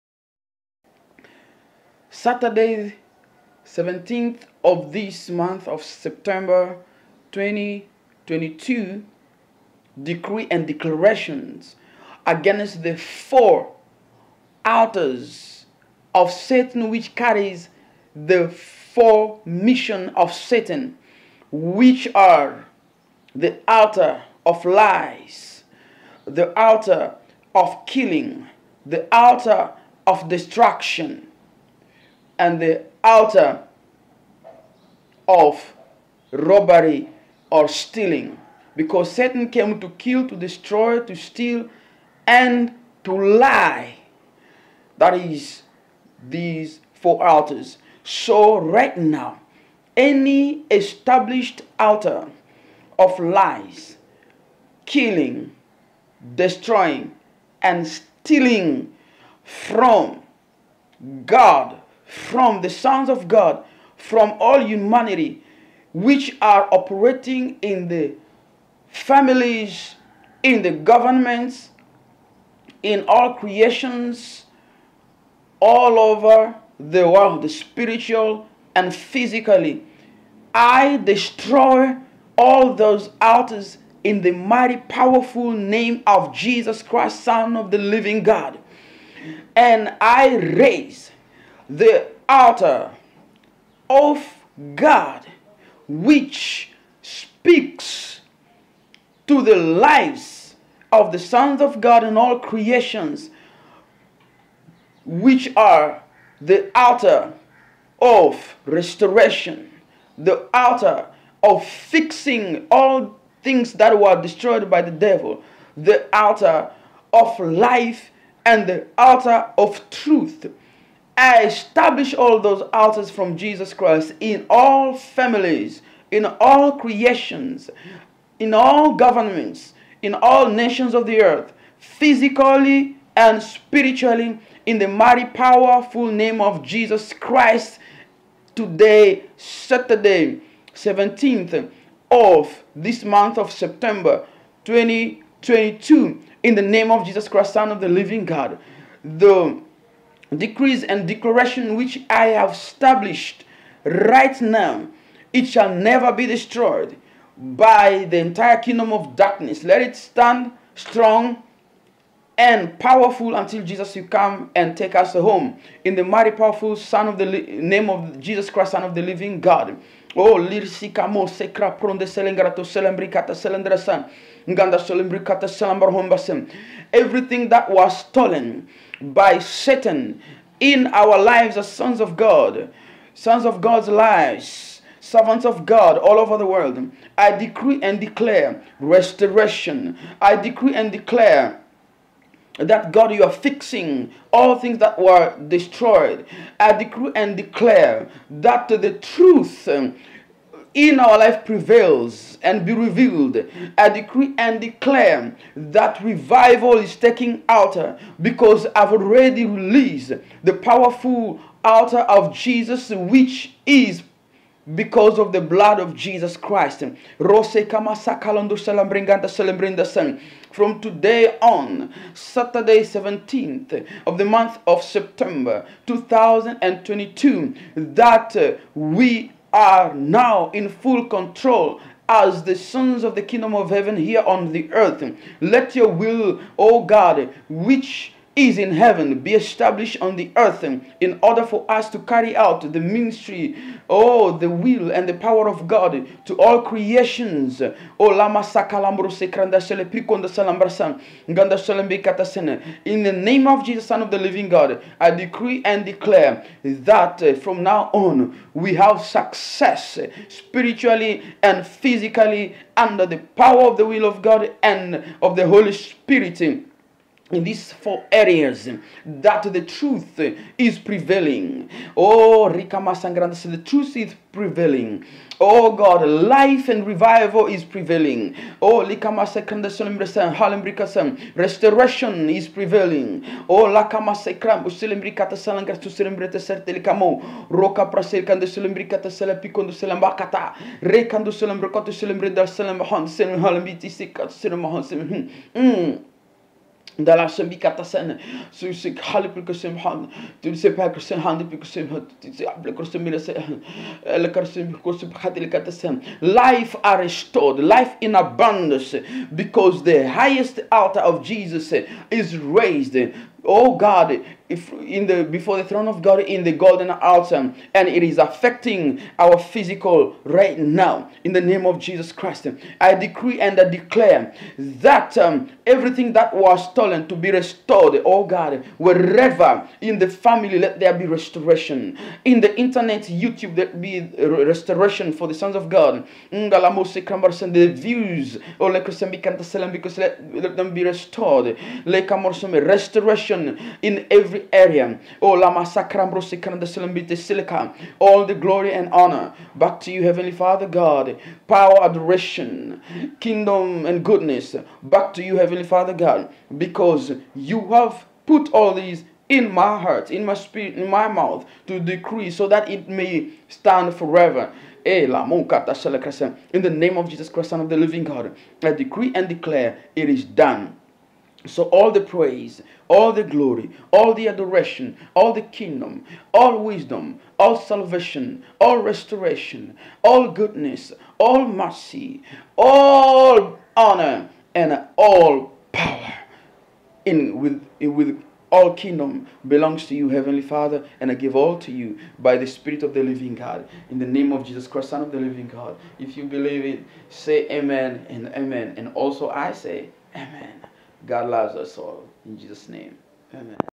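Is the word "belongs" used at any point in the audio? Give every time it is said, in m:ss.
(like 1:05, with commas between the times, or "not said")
6:29.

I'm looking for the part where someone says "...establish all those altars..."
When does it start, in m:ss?
2:01.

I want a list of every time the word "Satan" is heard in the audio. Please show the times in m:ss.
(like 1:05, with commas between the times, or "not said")
0:16, 0:20, 0:39, 2:59.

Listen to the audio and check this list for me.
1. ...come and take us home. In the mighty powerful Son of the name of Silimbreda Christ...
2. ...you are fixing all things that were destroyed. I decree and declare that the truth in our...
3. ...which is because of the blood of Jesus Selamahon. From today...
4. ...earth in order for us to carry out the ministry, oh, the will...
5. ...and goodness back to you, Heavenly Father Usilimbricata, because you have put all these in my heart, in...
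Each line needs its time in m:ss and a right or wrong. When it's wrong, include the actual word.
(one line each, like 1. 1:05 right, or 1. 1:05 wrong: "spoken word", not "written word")
1. 2:44 wrong: "Jesus", not "Silimbreda"
2. 3:13 right
3. 3:32 wrong: "Christ", not "Selamahon"
4. 4:00 right
5. 5:53 wrong: "God", not "Usilimbricata".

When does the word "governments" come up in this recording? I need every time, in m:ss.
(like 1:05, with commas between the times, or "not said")
1:10, 2:08.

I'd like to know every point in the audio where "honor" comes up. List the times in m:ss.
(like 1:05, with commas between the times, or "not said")
5:48, 6:23.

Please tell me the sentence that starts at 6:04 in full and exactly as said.
Eh, in the name of Jesus Christ, Son of the living God, I decree and declare it is done.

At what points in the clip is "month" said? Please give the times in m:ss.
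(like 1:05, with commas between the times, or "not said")
0:05, 2:23, 3:44.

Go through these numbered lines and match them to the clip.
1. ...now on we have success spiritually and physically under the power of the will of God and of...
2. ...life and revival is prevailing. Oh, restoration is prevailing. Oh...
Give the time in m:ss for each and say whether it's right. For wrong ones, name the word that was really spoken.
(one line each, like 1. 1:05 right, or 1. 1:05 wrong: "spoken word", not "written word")
1. 4:17 right
2. 4:36 right.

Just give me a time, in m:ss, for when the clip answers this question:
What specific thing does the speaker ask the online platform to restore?
5:36.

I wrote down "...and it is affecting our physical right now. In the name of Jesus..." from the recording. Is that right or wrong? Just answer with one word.
right.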